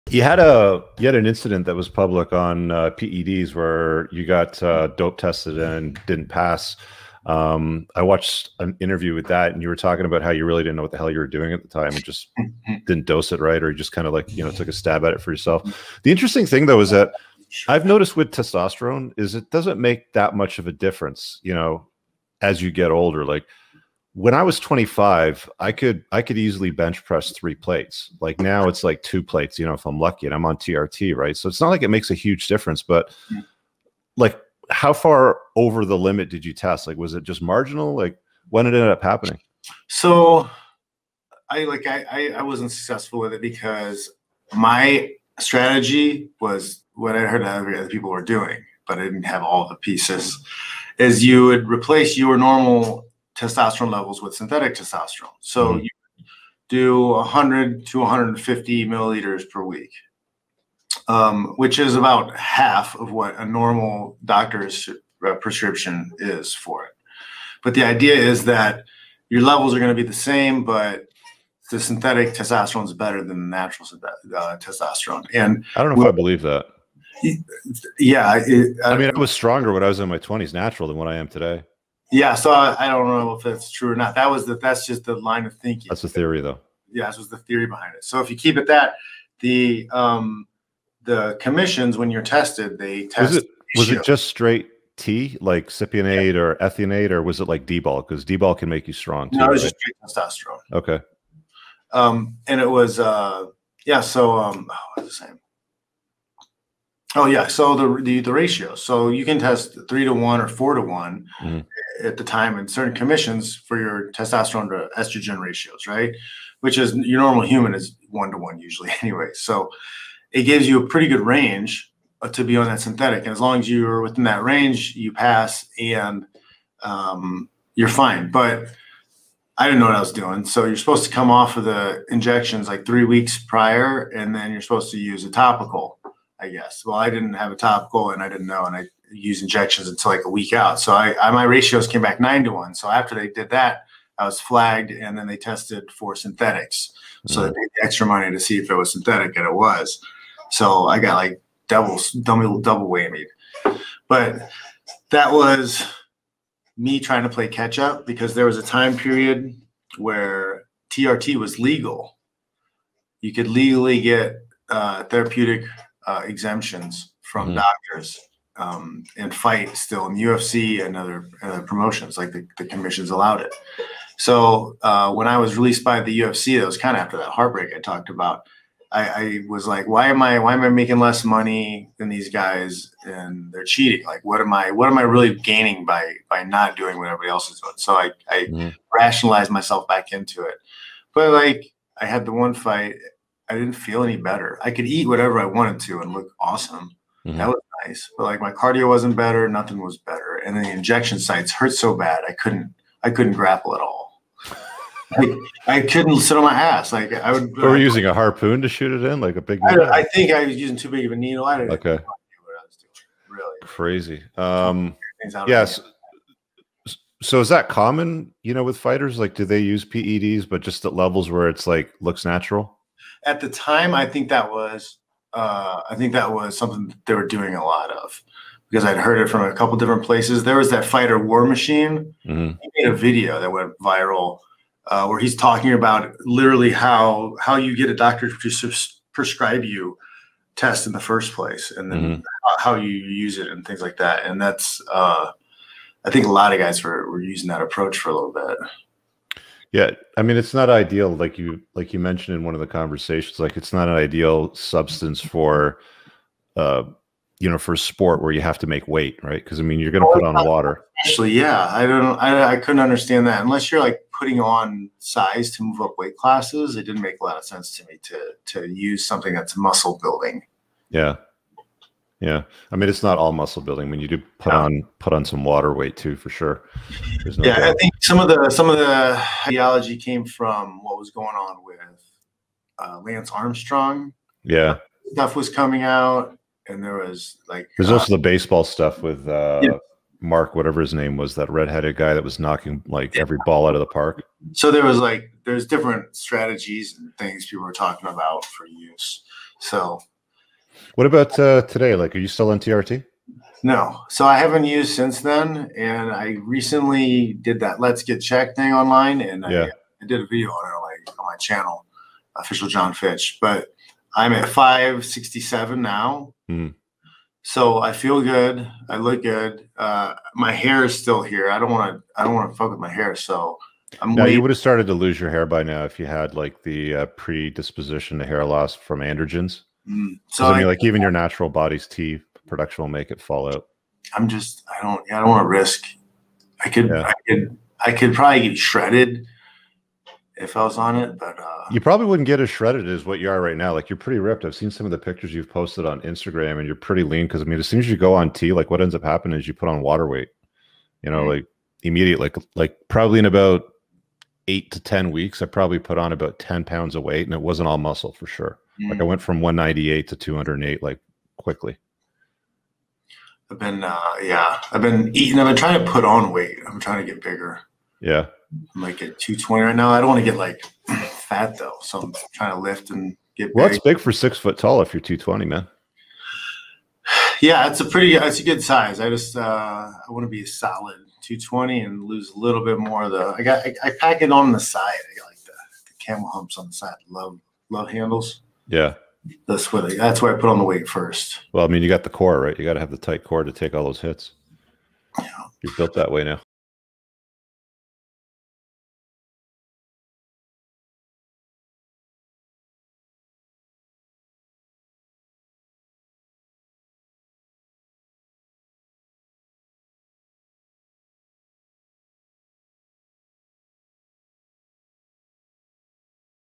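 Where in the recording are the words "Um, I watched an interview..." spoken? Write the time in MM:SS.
00:07.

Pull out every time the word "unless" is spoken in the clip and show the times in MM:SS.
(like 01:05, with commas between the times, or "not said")
04:23.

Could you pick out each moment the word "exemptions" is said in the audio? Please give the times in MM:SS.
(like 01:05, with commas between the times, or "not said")
02:46.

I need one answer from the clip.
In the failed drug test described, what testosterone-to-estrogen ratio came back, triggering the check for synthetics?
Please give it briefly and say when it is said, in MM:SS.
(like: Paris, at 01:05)
9 to 1, at 02:22.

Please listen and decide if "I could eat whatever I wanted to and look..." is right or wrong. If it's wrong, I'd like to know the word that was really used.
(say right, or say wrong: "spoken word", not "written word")
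right.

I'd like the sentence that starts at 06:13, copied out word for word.
Well, it's big for six foot tall if you're 220, man.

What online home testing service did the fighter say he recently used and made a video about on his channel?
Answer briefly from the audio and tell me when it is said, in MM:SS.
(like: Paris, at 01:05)
Let's Get Checked, at 05:07.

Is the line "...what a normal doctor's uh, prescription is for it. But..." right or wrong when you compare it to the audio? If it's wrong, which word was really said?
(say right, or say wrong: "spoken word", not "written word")
right.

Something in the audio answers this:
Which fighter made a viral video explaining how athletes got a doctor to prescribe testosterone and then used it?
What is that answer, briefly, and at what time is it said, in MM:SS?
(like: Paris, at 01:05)
War Machine, at 03:51.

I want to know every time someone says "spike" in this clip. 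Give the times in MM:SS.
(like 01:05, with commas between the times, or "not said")
not said.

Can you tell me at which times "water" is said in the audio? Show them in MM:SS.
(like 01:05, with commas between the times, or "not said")
04:20, 04:35, 05:49.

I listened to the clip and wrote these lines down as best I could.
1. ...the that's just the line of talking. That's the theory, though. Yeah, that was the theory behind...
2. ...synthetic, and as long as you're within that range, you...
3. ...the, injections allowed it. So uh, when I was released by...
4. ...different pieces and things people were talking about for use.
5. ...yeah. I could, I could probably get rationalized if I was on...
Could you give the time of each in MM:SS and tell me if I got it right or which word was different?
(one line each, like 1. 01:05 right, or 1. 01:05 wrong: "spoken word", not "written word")
1. 01:24 wrong: "thinking", not "talking"
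2. 02:02 right
3. 02:52 wrong: "commissions", not "injections"
4. 04:55 wrong: "strategies", not "pieces"
5. 05:36 wrong: "shredded", not "rationalized".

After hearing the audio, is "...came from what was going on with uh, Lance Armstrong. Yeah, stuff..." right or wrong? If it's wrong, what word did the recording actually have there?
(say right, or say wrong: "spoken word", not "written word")
right.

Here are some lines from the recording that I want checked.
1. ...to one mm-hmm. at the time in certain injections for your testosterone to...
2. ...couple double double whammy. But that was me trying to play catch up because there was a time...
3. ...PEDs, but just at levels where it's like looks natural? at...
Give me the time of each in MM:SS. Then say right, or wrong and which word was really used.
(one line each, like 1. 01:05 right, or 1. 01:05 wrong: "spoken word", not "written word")
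1. 01:50 wrong: "commissions", not "injections"
2. 02:31 wrong: "double", not "couple"
3. 03:39 right.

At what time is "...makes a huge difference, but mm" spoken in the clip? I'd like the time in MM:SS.
00:31.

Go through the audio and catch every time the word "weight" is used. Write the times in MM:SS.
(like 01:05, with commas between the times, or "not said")
04:18, 04:25, 04:35, 05:50, 05:57, 06:06, 06:30.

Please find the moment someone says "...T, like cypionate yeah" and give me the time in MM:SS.
01:34.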